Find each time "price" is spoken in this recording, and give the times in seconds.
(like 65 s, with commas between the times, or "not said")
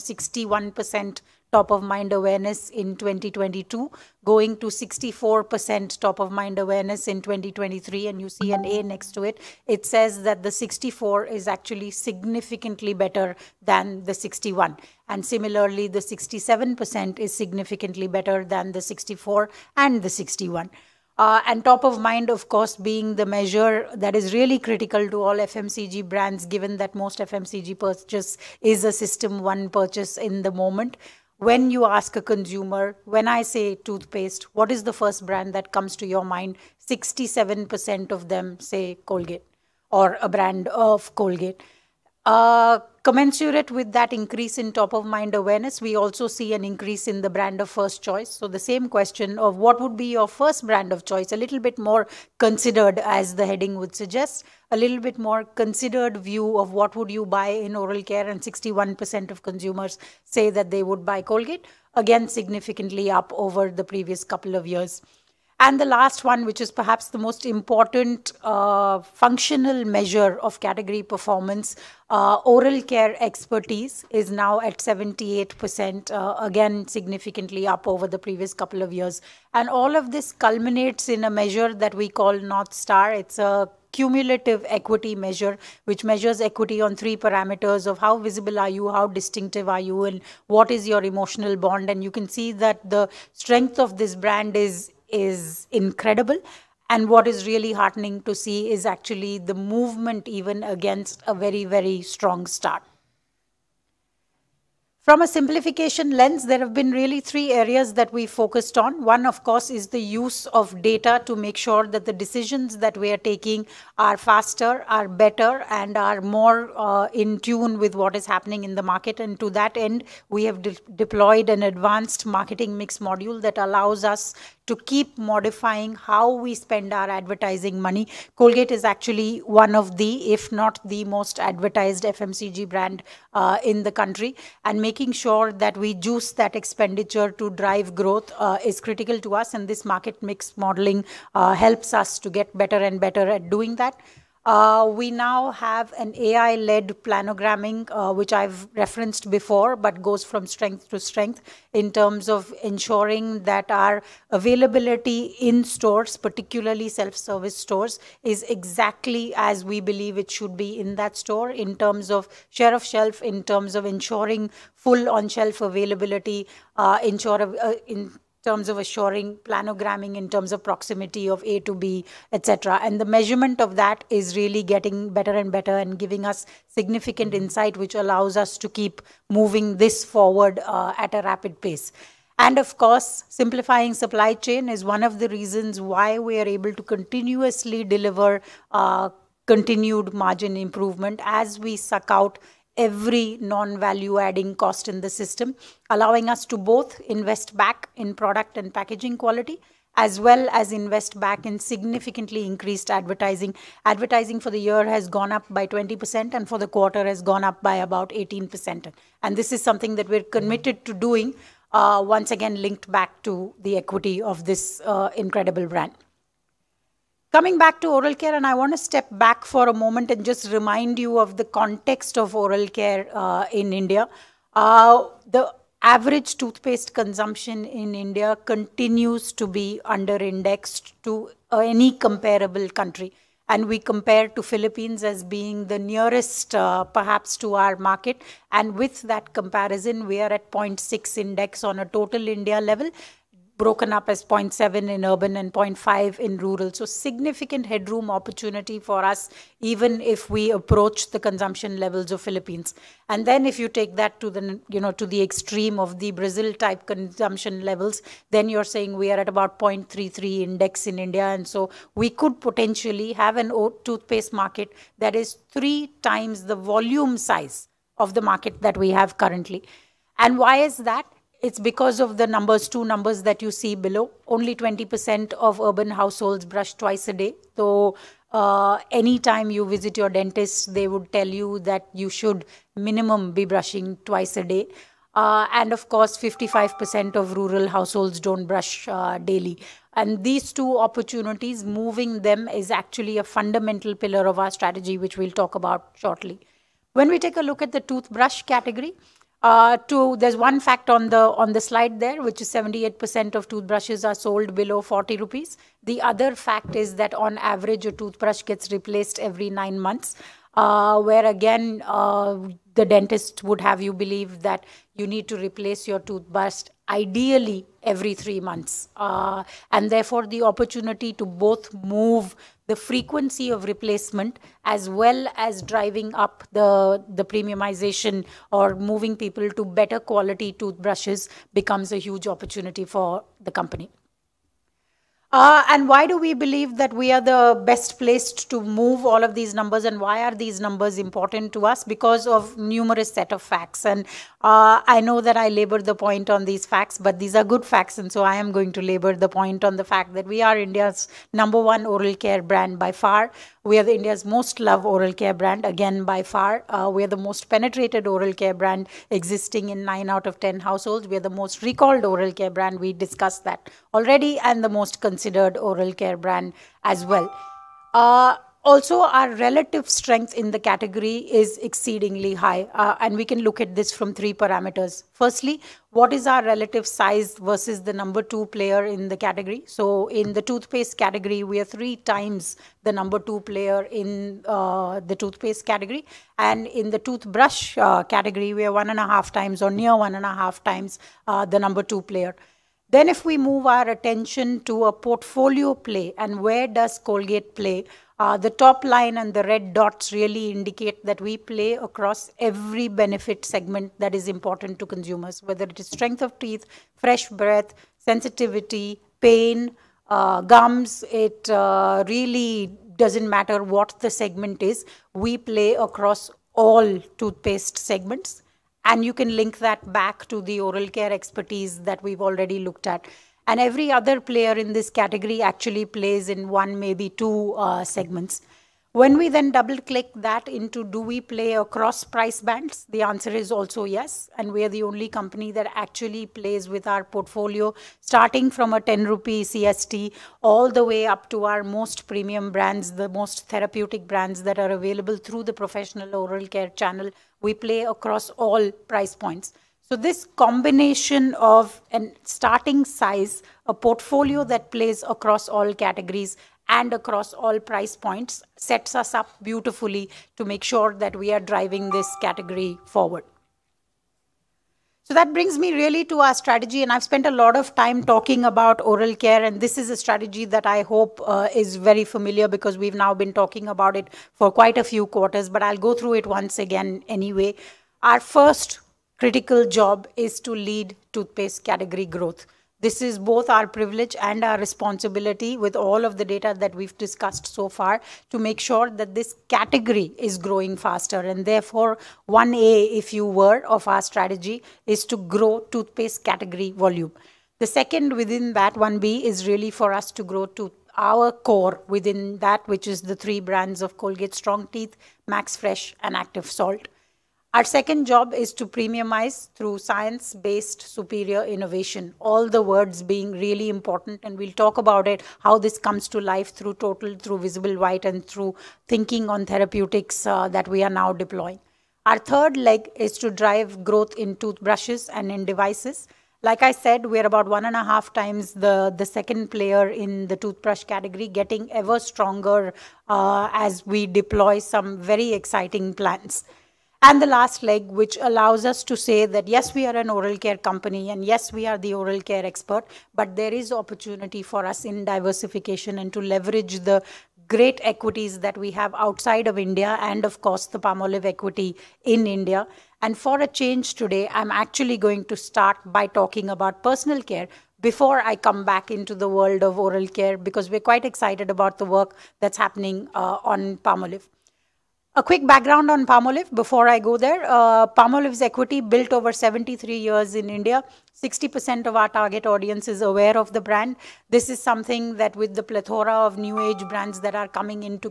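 432 s, 448 s, 457 s.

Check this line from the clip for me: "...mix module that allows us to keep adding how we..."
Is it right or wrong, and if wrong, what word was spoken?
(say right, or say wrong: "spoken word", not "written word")
wrong: "modifying", not "adding".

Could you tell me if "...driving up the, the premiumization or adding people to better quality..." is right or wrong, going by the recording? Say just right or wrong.
wrong.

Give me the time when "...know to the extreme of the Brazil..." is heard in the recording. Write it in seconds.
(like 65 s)
254 s.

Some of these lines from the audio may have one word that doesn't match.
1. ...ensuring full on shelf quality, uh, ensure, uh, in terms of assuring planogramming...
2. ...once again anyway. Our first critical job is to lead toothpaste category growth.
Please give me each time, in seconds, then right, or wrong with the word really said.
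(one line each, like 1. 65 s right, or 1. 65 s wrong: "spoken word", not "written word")
1. 163 s wrong: "availability", not "quality"
2. 476 s right.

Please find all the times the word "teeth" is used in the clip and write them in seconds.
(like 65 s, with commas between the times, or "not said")
406 s, 504 s.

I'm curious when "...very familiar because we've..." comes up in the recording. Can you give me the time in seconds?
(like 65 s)
471 s.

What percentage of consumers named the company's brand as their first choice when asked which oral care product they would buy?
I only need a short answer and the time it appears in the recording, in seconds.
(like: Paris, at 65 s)
61%, at 58 s.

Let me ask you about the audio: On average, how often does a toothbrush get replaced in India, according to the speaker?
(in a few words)
every 9 months.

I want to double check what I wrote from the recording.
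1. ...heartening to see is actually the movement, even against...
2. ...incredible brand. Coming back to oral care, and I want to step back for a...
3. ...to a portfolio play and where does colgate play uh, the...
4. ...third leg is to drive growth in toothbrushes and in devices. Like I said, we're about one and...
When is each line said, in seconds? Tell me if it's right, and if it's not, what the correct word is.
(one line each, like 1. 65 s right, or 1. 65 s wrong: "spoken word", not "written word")
1. 97 s right
2. 215 s right
3. 394 s right
4. 522 s right.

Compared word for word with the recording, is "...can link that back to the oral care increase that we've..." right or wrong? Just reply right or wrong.
wrong.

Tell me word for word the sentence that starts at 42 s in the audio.
Uh, Commensurate with that increase in top of mind awareness, we also see an increase in the brand of first choice.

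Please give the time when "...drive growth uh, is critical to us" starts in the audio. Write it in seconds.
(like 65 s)
137 s.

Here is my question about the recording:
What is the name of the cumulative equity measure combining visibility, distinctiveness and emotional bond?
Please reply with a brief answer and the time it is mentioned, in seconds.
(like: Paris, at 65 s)
North Star, at 82 s.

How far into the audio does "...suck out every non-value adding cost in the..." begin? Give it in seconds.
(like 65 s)
191 s.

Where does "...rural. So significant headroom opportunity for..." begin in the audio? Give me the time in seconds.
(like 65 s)
246 s.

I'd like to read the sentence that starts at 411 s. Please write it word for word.
It uh, really doesn't matter what the segment is.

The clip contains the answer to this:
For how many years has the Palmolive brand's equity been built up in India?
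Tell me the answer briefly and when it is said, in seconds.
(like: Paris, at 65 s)
73 years, at 569 s.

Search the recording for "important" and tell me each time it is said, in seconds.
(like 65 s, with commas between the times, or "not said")
67 s, 340 s, 404 s, 513 s.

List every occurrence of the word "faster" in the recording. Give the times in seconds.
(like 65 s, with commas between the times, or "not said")
114 s, 490 s.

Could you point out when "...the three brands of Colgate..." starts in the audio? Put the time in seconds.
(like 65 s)
503 s.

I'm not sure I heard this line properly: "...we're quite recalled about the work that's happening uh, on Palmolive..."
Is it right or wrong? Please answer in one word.
wrong.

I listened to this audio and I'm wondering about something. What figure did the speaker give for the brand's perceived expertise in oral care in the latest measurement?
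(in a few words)
78%.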